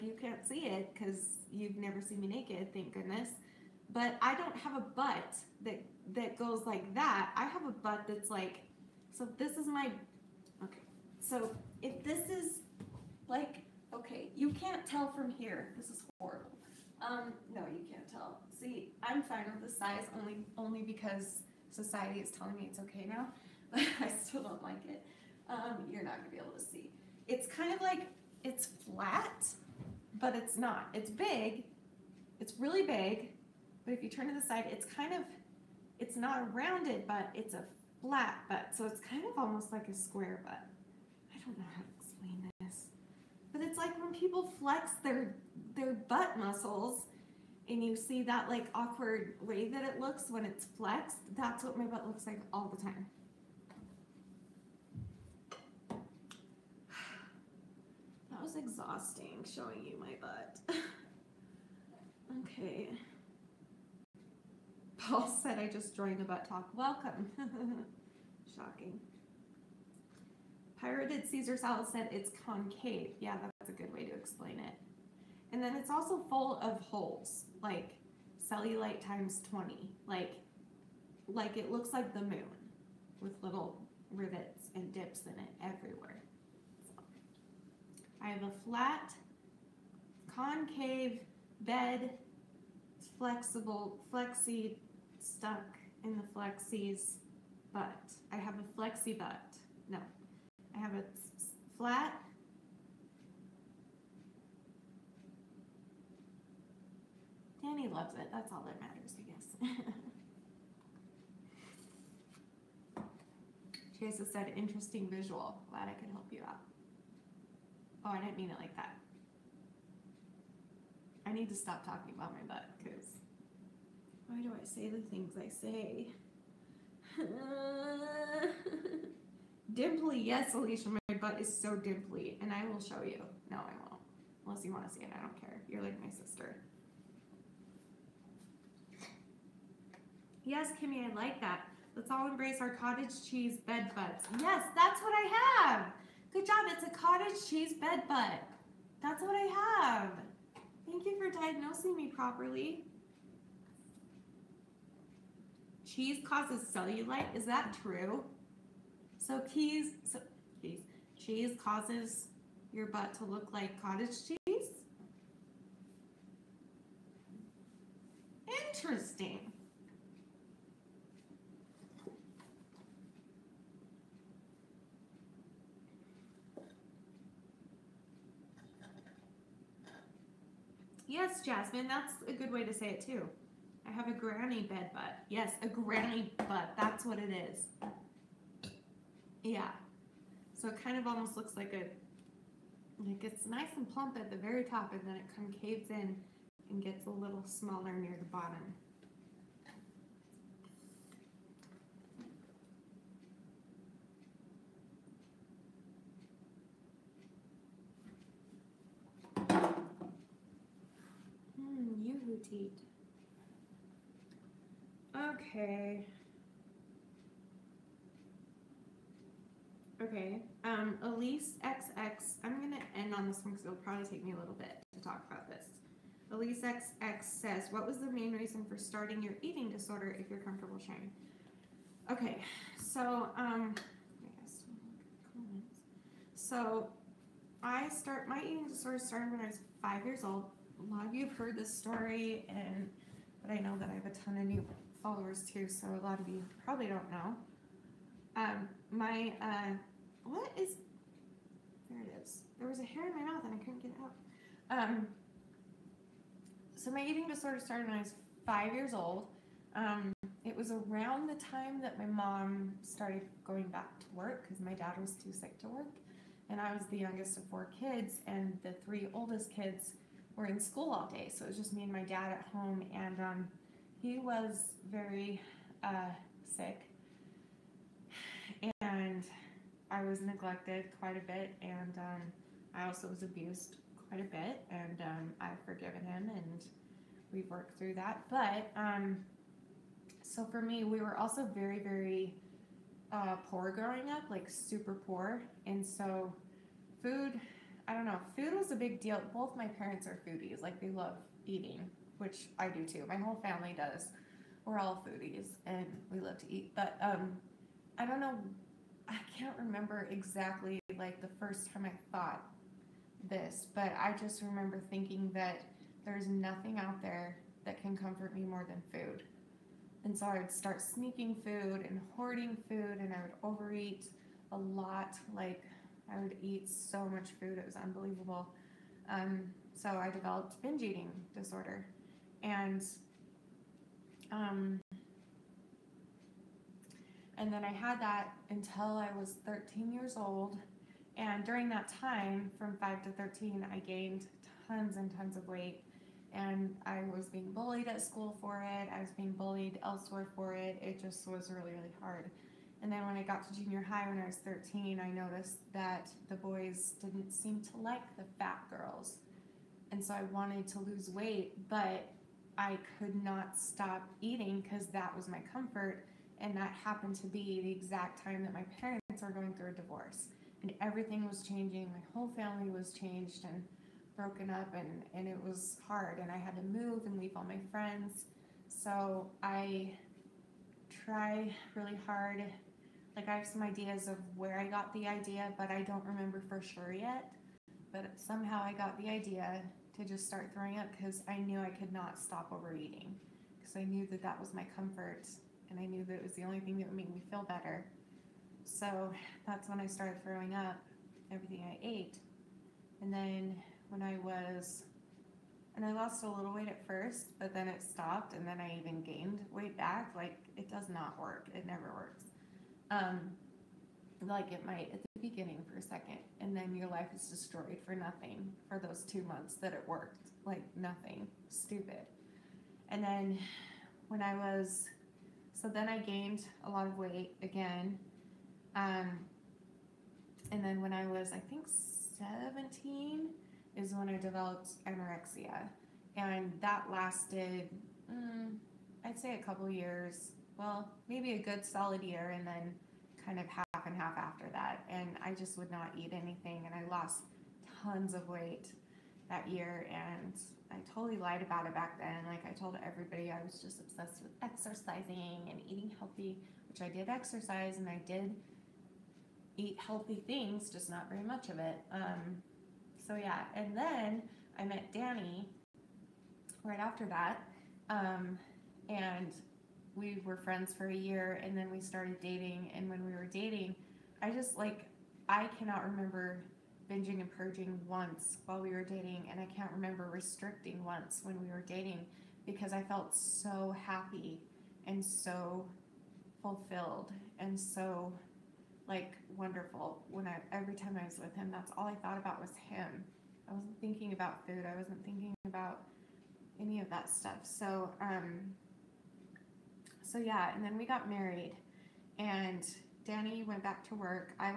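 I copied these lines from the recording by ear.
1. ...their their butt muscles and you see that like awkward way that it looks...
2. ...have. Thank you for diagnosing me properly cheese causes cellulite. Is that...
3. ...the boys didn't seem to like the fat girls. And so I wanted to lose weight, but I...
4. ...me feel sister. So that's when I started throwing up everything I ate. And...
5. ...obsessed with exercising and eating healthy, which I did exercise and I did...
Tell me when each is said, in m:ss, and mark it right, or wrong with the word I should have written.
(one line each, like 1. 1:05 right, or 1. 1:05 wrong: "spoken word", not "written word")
1. 0:45 right
2. 2:29 right
3. 5:56 right
4. 6:37 wrong: "better", not "sister"
5. 7:33 right.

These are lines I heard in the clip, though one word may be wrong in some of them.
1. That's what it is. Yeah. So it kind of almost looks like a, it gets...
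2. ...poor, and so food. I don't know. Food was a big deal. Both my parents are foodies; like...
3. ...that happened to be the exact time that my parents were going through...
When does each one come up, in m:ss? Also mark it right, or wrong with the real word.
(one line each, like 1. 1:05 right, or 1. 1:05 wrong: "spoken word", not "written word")
1. 3:06 right
2. 4:54 right
3. 6:06 right.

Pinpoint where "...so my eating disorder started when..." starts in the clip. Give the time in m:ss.
4:16.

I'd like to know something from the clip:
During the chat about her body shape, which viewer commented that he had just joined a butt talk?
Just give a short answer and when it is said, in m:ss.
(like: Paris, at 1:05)
Paul, at 1:05.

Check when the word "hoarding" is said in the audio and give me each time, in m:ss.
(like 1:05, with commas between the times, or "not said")
5:22.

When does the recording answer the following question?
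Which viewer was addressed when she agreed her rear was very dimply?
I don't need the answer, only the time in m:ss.
2:10.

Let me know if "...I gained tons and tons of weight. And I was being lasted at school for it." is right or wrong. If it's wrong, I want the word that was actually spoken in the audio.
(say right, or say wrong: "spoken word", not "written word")
wrong: "bullied", not "lasted".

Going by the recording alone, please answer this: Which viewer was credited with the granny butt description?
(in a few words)
Jasmine.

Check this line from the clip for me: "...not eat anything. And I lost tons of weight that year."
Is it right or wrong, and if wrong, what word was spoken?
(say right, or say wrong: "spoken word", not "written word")
right.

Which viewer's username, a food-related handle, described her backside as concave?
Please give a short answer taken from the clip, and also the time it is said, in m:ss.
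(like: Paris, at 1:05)
Pirated Caesar salad, at 1:10.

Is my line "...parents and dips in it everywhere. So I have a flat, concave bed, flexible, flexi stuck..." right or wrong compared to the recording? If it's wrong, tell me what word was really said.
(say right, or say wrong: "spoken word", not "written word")
wrong: "rivets", not "parents".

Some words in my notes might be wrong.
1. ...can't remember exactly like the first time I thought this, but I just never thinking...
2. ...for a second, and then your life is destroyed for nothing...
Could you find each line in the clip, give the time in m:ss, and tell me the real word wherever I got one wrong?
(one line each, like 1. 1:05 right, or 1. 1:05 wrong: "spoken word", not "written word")
1. 5:09 wrong: "remember", not "never"
2. 6:55 right.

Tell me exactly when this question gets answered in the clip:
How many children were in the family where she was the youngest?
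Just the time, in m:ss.
4:27.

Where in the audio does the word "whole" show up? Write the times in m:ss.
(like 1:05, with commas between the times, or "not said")
5:03, 6:12.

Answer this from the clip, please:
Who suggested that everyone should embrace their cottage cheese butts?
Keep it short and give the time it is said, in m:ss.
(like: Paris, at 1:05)
Kimmy, at 2:20.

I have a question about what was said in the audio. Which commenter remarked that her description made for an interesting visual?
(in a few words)
Chase.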